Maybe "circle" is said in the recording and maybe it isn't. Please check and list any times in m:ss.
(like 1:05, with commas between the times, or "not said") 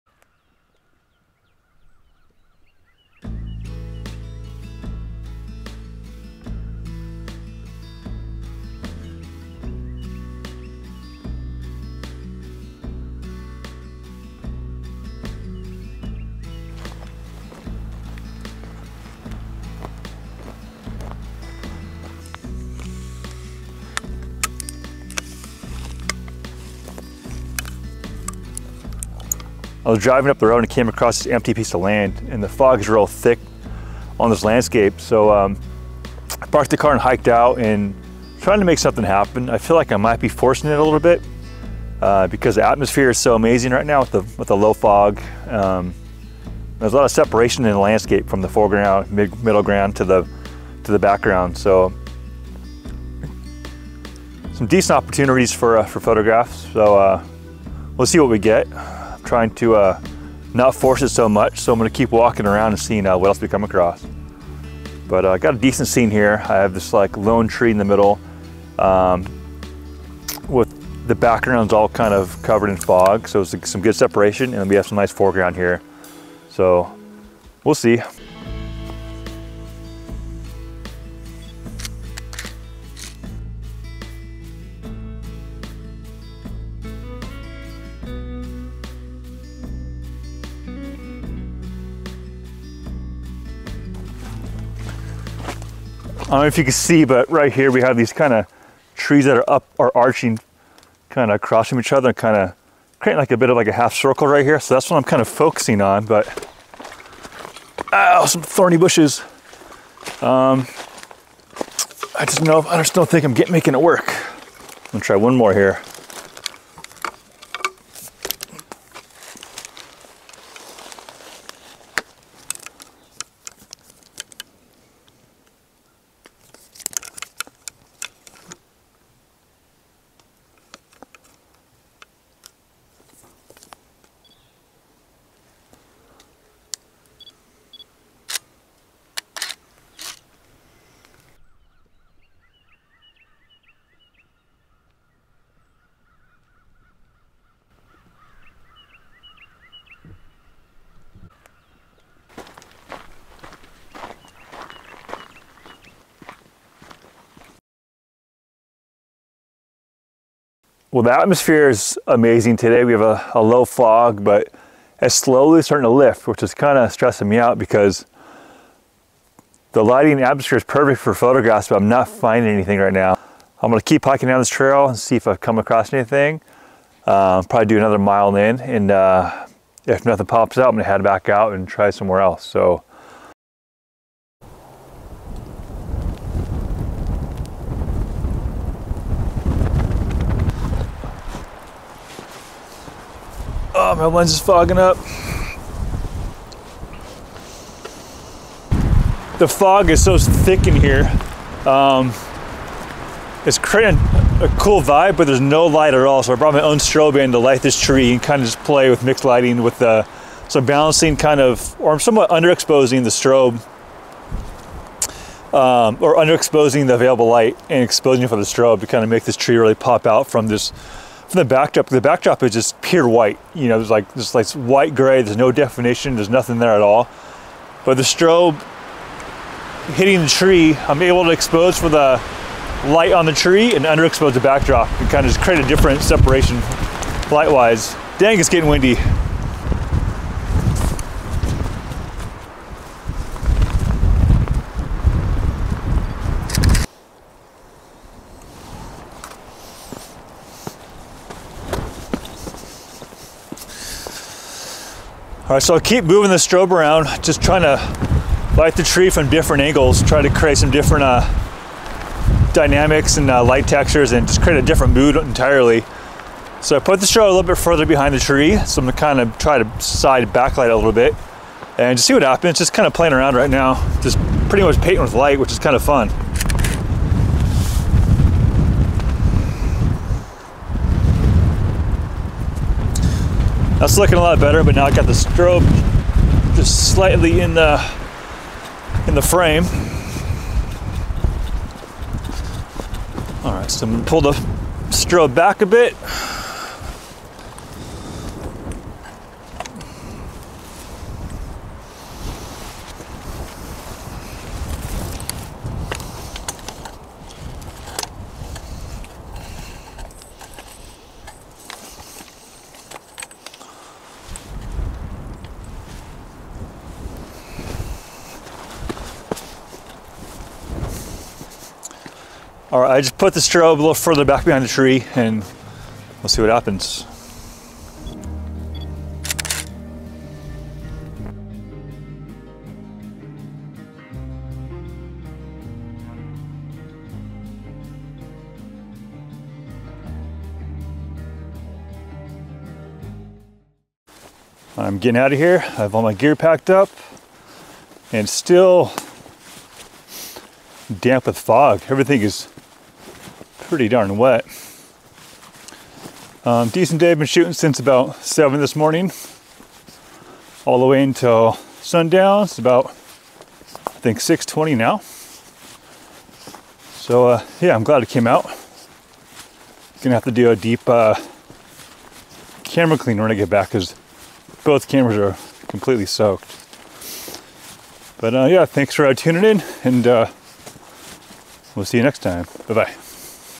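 1:43.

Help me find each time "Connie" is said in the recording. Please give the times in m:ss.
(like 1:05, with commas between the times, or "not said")
not said.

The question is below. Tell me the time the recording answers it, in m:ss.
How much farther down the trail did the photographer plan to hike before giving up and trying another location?
2:57.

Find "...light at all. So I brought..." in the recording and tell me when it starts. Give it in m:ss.
3:25.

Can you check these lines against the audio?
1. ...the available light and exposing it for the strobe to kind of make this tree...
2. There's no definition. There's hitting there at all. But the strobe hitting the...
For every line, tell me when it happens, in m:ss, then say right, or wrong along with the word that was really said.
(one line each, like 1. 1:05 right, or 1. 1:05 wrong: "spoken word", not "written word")
1. 3:36 right
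2. 3:45 wrong: "nothing", not "hitting".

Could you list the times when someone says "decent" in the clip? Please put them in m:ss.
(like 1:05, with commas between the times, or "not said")
0:54, 1:05, 5:56.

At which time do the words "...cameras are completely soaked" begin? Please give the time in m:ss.
6:14.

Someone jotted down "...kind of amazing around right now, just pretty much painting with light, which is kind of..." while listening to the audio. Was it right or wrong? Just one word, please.
wrong.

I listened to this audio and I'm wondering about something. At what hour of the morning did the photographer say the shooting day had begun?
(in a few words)
7.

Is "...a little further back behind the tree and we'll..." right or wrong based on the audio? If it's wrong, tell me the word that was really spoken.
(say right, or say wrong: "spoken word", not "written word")
right.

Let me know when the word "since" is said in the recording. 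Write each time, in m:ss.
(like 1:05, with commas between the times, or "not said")
5:57.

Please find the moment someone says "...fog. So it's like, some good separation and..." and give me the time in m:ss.
1:12.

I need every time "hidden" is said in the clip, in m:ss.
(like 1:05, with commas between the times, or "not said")
not said.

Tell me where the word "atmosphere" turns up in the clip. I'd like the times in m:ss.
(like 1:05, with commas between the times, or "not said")
0:42, 2:41, 2:50.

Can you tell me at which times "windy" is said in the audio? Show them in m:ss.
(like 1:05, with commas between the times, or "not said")
3:58.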